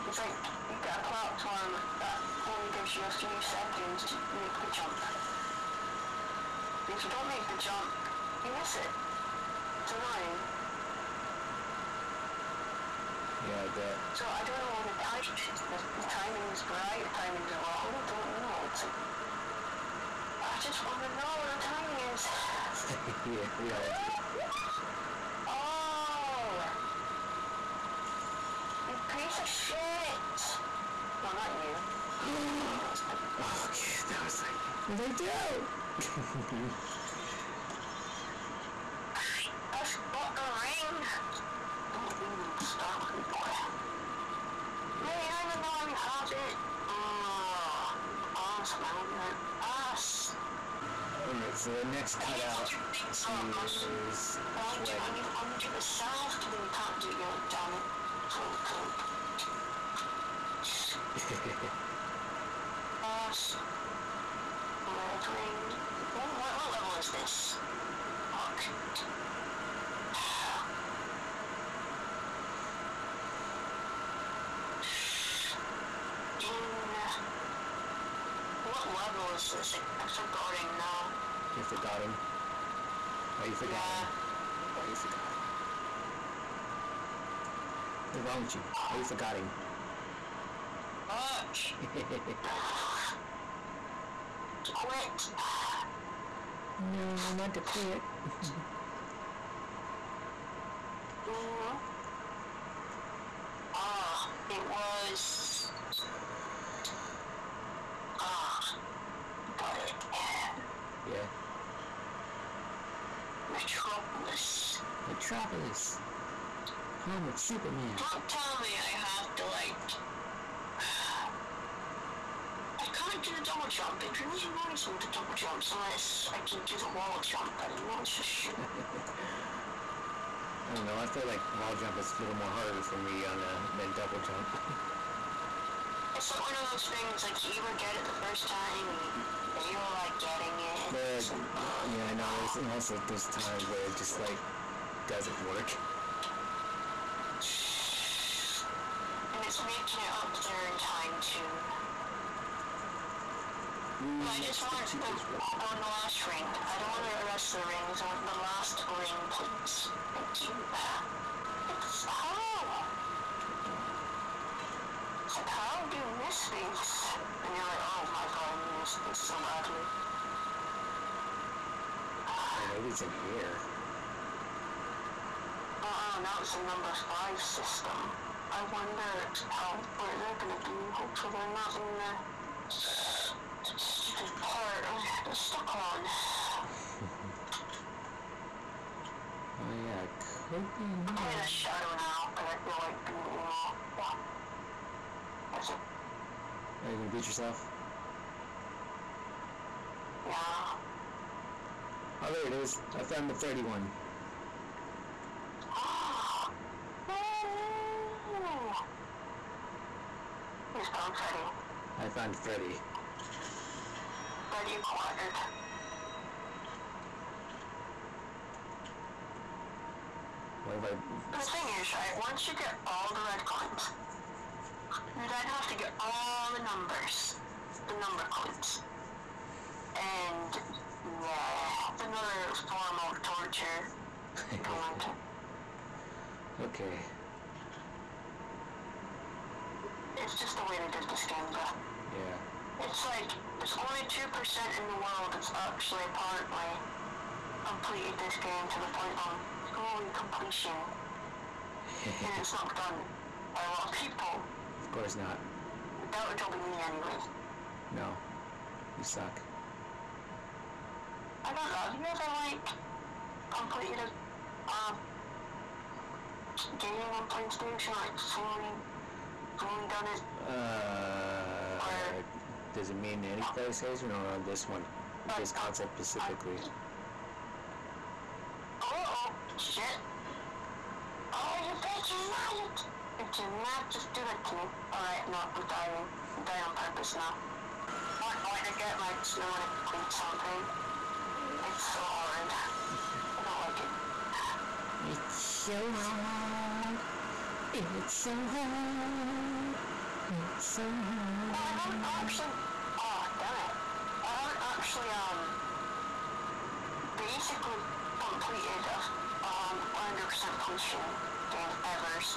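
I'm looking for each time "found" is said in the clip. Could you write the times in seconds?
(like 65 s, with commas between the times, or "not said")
203 s, 212 s.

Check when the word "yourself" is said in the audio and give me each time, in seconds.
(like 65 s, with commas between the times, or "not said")
55 s, 197 s.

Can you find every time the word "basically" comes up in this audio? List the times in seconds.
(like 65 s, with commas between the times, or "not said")
307 s.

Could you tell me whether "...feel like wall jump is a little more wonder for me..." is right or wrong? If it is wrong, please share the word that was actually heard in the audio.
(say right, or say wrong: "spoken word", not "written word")
wrong: "harder", not "wonder".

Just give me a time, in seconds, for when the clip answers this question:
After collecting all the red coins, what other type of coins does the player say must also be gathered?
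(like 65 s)
227 s.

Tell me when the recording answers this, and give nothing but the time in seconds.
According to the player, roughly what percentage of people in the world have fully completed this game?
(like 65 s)
244 s.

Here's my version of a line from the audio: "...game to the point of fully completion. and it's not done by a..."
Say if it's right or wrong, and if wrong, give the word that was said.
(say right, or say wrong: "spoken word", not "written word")
right.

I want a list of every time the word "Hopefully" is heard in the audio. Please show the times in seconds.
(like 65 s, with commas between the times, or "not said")
180 s.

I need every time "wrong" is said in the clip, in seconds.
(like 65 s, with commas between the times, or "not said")
17 s, 88 s.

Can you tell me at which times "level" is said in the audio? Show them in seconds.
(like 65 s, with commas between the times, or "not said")
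66 s, 78 s.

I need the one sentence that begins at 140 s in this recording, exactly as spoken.
There are, like, oh, yeah, I know, wow.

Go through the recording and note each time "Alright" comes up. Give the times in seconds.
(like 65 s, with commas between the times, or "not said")
51 s, 284 s.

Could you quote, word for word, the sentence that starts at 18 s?
It's like, I just want to know what the timing is.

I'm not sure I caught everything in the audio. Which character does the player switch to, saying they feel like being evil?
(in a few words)
Shadow.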